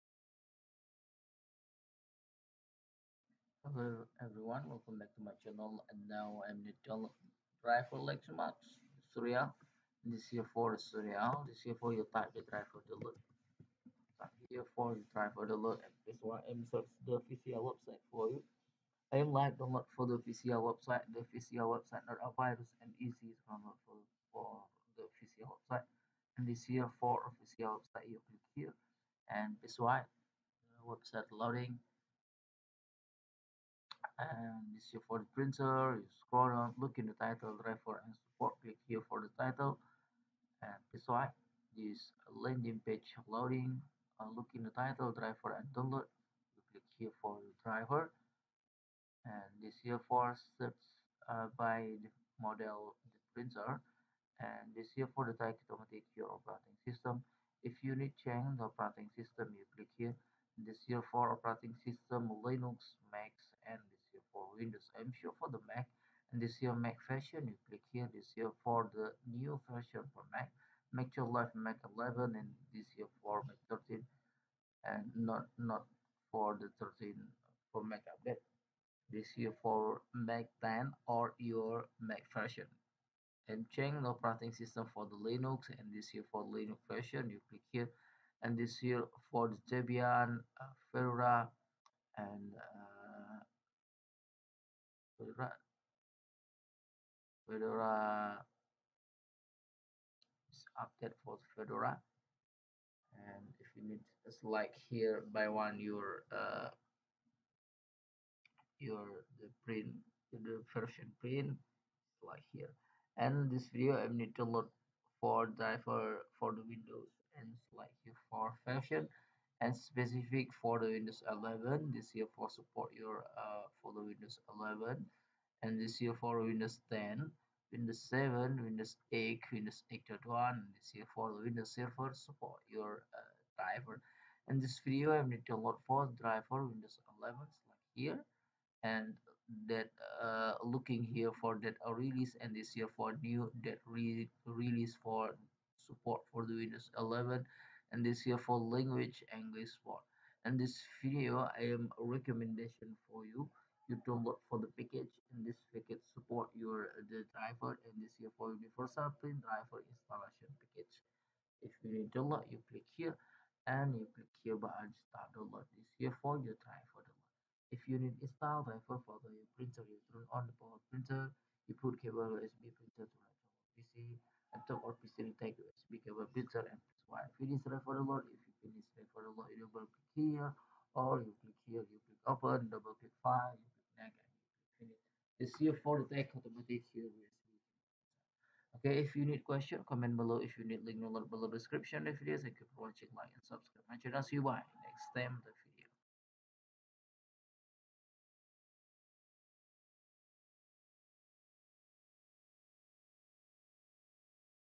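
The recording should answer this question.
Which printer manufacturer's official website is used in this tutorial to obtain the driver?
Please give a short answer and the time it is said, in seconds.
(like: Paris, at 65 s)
Lexmark, at 8 s.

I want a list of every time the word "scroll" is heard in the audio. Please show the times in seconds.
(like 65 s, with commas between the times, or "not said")
36 s.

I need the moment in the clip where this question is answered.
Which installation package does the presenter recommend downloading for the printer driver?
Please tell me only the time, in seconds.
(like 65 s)
158 s.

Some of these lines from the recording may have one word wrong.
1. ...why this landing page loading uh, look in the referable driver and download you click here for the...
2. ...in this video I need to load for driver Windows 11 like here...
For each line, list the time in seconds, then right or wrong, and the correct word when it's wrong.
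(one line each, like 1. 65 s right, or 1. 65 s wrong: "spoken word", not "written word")
1. 41 s wrong: "title", not "referable"
2. 134 s right.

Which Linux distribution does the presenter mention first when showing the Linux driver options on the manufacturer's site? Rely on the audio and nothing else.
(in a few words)
Debian.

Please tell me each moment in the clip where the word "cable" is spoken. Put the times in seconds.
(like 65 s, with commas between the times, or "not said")
172 s, 176 s.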